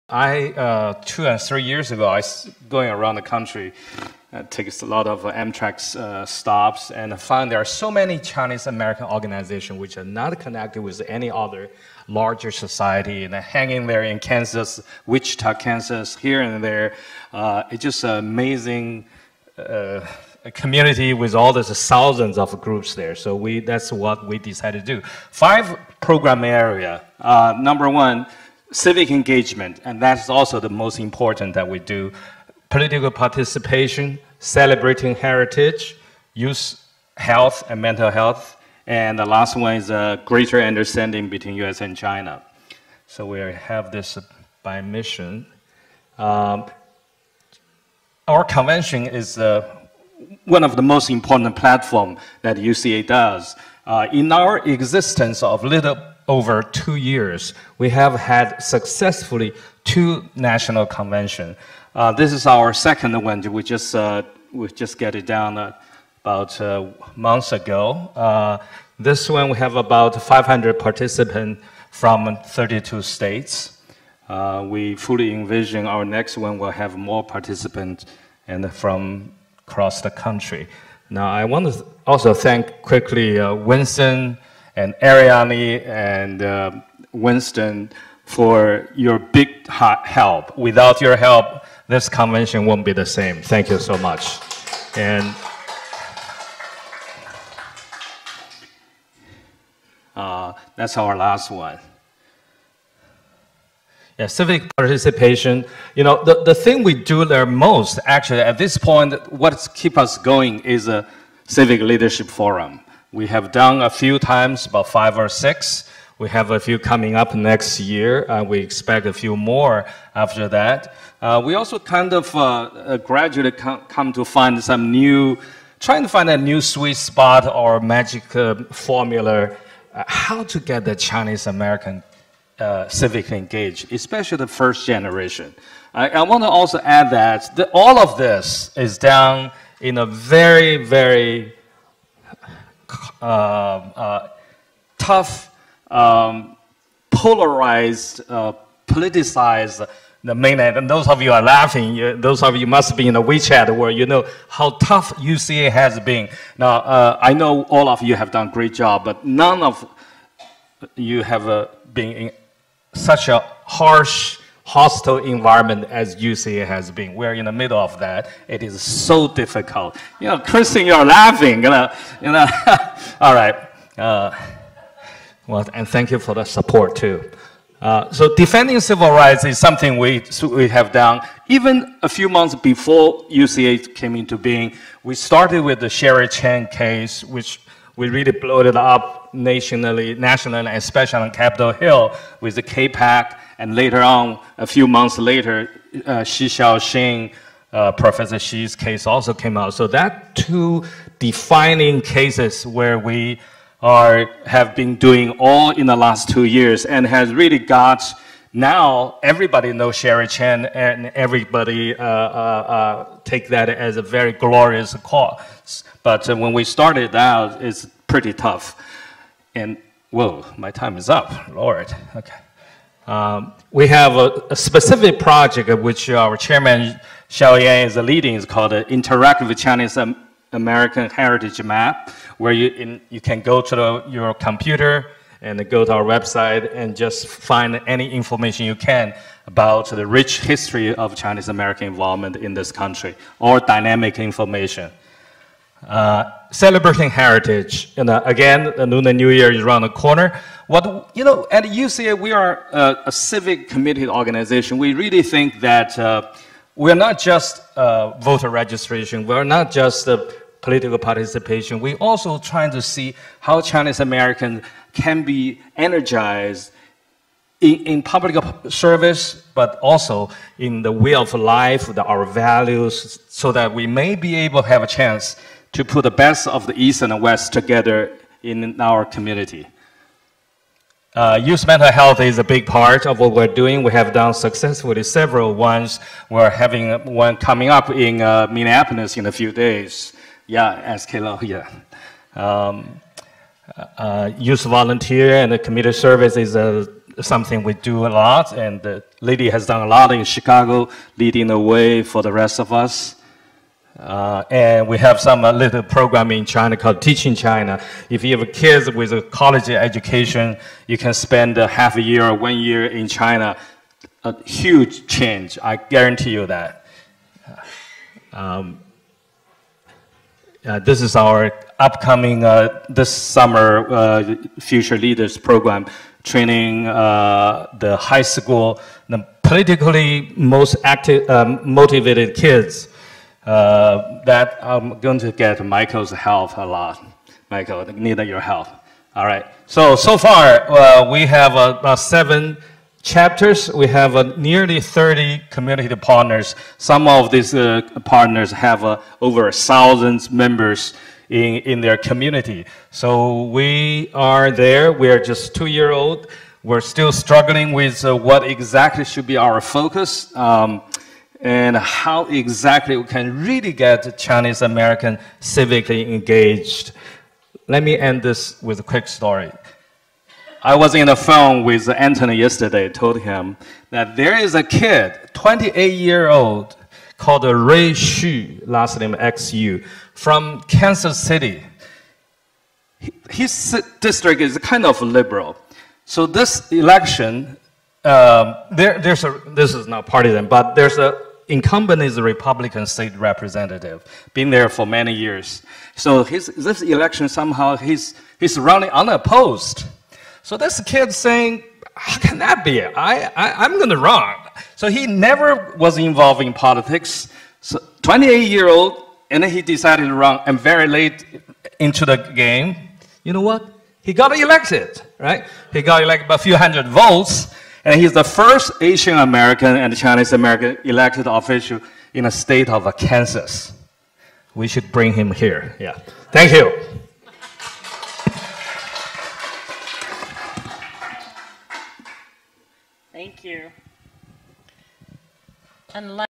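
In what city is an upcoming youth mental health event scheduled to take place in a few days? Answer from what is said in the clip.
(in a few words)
Minneapolis.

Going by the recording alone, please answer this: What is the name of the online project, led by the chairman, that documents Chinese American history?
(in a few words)
Interactive Chinese American Heritage Map.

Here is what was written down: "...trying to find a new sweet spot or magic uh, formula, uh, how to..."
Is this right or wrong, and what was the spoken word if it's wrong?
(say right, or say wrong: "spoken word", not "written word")
right.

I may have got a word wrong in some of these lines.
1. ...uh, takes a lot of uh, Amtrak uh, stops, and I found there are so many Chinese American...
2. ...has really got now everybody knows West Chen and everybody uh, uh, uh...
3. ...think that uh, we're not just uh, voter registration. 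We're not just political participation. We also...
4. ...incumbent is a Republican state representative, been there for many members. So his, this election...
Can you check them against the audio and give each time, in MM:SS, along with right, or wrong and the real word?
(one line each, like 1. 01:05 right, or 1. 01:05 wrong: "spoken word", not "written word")
1. 00:04 right
2. 03:27 wrong: "Sherry", not "West"
3. 04:15 right
4. 06:31 wrong: "years", not "members".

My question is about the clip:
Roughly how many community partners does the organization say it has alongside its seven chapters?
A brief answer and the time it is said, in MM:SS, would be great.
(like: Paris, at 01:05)
30, at 05:44.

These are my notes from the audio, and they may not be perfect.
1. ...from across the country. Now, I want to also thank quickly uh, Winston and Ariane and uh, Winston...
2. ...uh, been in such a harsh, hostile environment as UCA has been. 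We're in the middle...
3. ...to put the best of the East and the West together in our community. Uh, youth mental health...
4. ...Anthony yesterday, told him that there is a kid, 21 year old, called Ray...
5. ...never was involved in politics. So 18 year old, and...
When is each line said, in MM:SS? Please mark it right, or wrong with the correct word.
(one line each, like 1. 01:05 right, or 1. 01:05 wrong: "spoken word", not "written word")
1. 01:18 right
2. 02:41 right
3. 04:35 right
4. 06:11 wrong: "28", not "21"
5. 06:45 wrong: "28", not "18".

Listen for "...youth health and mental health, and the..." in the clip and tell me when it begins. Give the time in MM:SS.
00:36.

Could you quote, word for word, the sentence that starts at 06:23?
His district is kind of liberal.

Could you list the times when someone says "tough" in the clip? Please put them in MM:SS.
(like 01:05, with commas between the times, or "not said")
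02:24, 02:34, 03:38.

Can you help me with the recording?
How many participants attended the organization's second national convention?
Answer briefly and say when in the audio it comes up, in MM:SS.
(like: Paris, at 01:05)
500, at 01:10.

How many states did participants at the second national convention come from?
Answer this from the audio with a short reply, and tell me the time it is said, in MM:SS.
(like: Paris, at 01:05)
32, at 01:12.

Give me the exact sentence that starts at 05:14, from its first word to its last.
A huge change, I guarantee you that.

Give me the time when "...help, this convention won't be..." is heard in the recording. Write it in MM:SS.
01:31.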